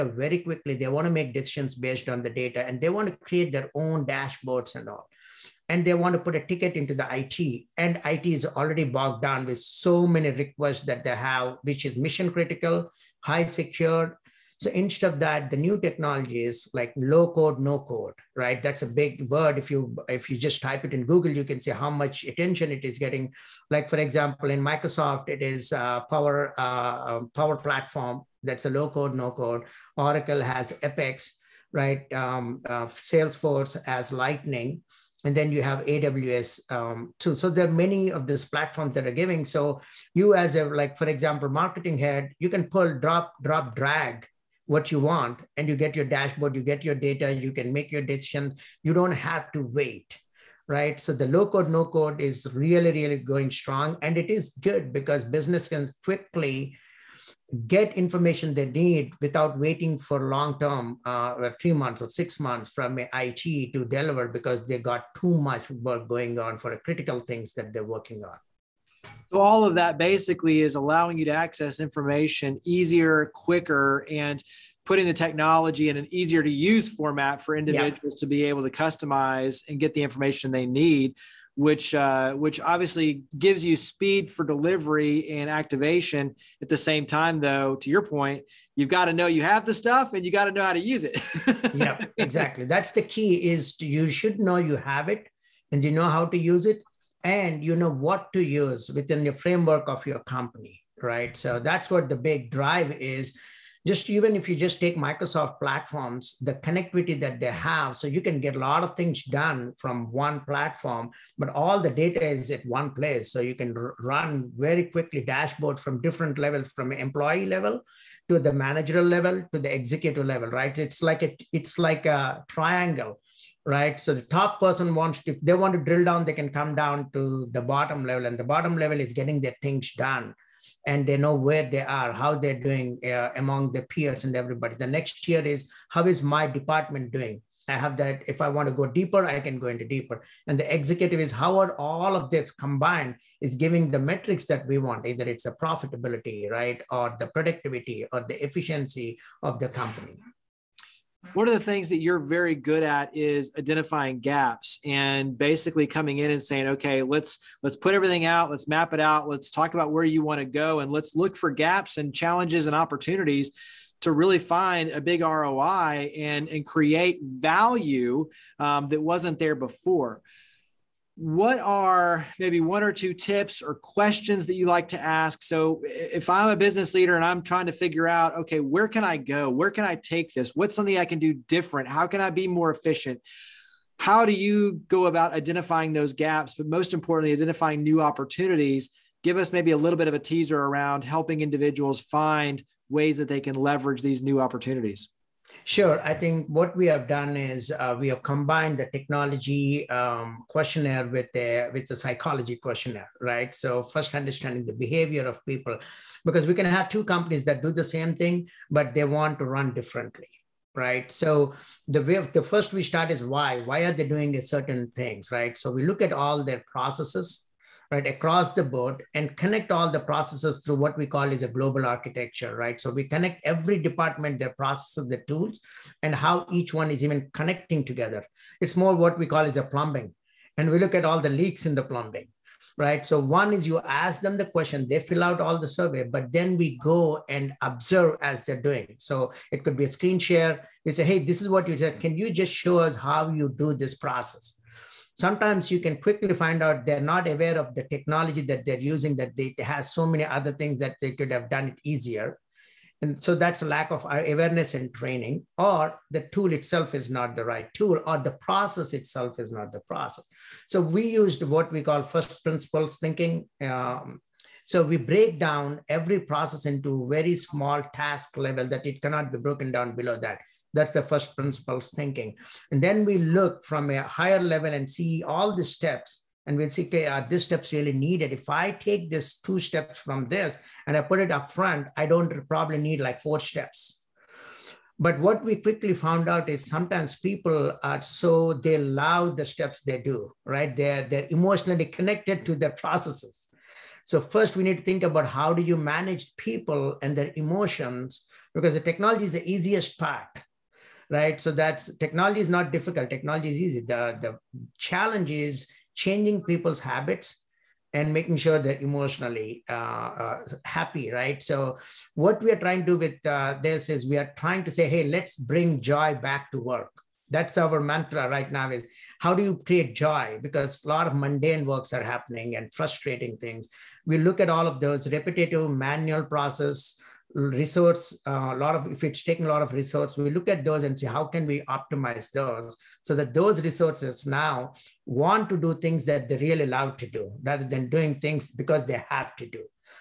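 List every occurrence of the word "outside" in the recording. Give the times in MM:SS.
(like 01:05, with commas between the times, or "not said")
not said.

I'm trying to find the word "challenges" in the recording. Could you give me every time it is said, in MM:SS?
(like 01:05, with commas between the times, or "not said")
02:42, 05:04.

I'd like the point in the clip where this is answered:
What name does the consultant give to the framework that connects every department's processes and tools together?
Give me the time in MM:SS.
03:41.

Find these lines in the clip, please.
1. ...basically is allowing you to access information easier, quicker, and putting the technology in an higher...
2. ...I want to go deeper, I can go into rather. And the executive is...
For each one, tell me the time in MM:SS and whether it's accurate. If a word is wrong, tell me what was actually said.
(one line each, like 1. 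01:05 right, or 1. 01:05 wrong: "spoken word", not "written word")
1. 01:09 wrong: "easier", not "higher"
2. 02:18 wrong: "deeper", not "rather".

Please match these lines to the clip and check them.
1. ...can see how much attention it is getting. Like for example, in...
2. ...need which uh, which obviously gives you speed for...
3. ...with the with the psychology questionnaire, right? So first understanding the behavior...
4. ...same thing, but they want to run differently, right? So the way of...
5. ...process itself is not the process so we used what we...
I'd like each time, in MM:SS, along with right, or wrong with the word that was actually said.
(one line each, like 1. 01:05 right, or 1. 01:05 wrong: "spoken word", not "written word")
1. 00:21 right
2. 01:20 right
3. 03:21 right
4. 03:27 right
5. 04:18 right.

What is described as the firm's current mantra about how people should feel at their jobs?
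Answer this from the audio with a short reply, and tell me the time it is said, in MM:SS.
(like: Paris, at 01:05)
Bring joy back to work, at 05:15.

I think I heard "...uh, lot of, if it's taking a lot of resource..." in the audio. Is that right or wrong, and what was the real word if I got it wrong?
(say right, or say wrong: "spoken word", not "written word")
right.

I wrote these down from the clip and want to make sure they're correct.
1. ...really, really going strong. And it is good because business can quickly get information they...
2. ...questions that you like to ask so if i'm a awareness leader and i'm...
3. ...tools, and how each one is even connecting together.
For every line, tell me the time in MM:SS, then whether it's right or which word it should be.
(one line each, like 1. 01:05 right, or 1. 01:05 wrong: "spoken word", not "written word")
1. 00:52 right
2. 02:53 wrong: "business", not "awareness"
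3. 03:45 right.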